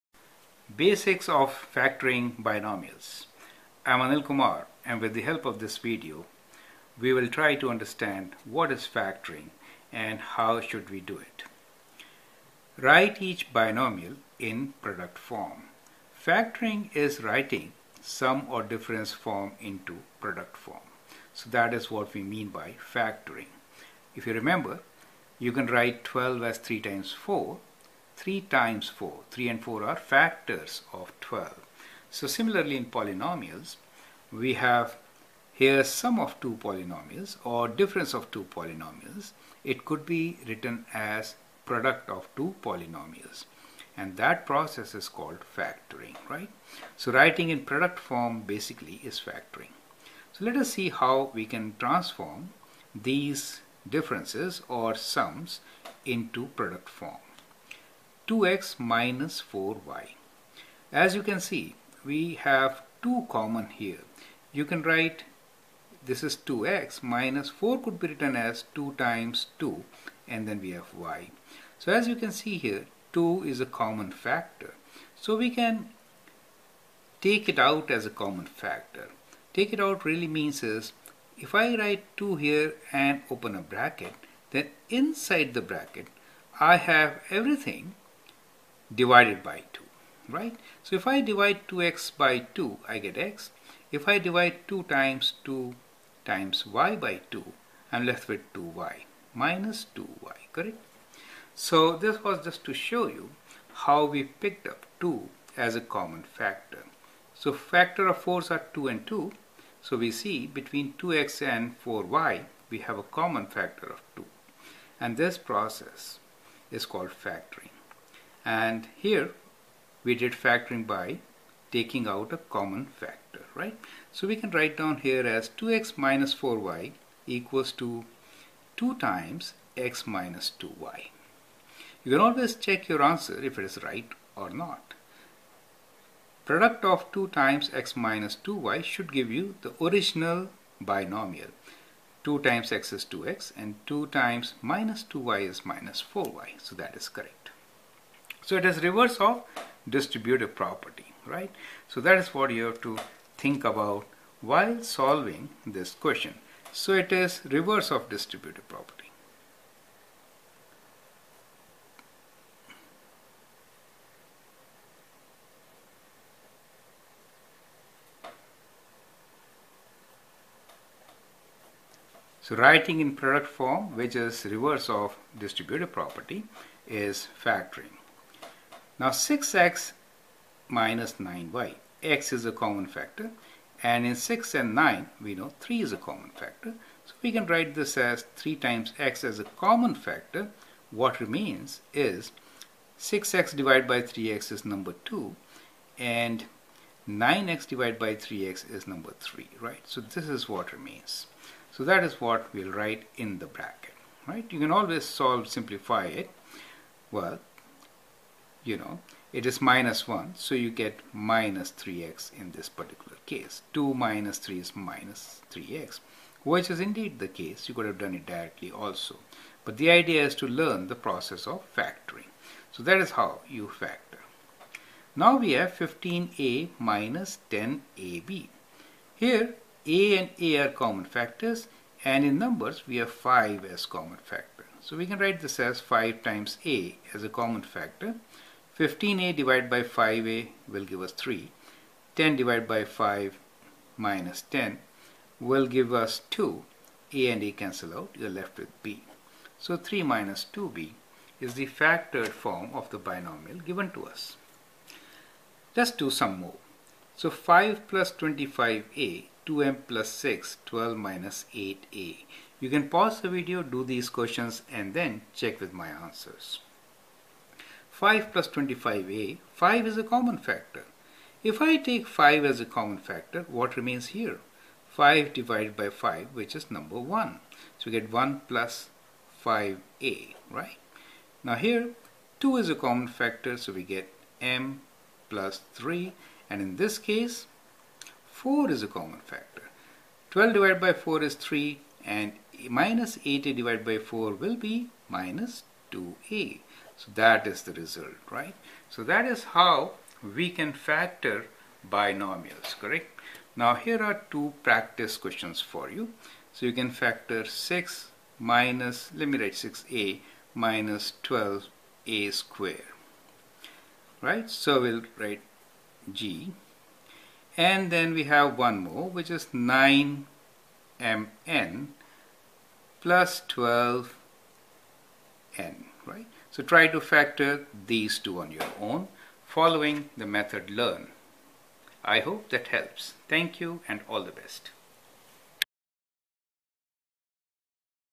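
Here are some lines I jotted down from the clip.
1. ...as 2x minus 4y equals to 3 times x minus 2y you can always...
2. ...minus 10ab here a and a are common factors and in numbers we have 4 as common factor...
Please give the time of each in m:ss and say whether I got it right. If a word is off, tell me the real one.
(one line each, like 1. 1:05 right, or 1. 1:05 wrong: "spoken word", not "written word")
1. 2:05 wrong: "2", not "3"
2. 3:46 wrong: "5", not "4".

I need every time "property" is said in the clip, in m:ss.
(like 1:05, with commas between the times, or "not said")
2:30, 2:38, 2:55.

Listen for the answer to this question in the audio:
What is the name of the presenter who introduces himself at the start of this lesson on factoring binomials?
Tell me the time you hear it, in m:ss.
0:03.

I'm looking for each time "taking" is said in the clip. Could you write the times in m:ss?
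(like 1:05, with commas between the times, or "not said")
2:01.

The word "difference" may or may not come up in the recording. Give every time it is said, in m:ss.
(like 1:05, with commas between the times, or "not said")
0:18, 0:37, 0:53.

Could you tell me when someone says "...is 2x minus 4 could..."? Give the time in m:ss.
1:06.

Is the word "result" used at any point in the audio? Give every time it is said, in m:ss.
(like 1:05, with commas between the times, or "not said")
4:57.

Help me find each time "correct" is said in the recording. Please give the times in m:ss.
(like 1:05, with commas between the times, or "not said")
1:40, 2:27, 5:02.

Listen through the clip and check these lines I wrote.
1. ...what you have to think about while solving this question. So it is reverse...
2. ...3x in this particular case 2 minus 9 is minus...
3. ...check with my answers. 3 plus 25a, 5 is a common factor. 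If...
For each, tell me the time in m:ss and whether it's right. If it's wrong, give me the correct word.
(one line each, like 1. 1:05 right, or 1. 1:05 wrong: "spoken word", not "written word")
1. 2:32 right
2. 3:31 wrong: "3", not "9"
3. 4:25 wrong: "5", not "3".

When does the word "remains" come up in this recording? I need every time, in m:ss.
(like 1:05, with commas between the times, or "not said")
3:11, 3:20, 4:33.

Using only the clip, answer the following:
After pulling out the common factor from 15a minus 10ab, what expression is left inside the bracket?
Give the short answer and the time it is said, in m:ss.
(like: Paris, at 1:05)
3 minus 2b, at 4:09.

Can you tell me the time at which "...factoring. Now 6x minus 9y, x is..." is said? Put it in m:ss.
2:57.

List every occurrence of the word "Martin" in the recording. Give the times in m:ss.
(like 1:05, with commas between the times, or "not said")
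not said.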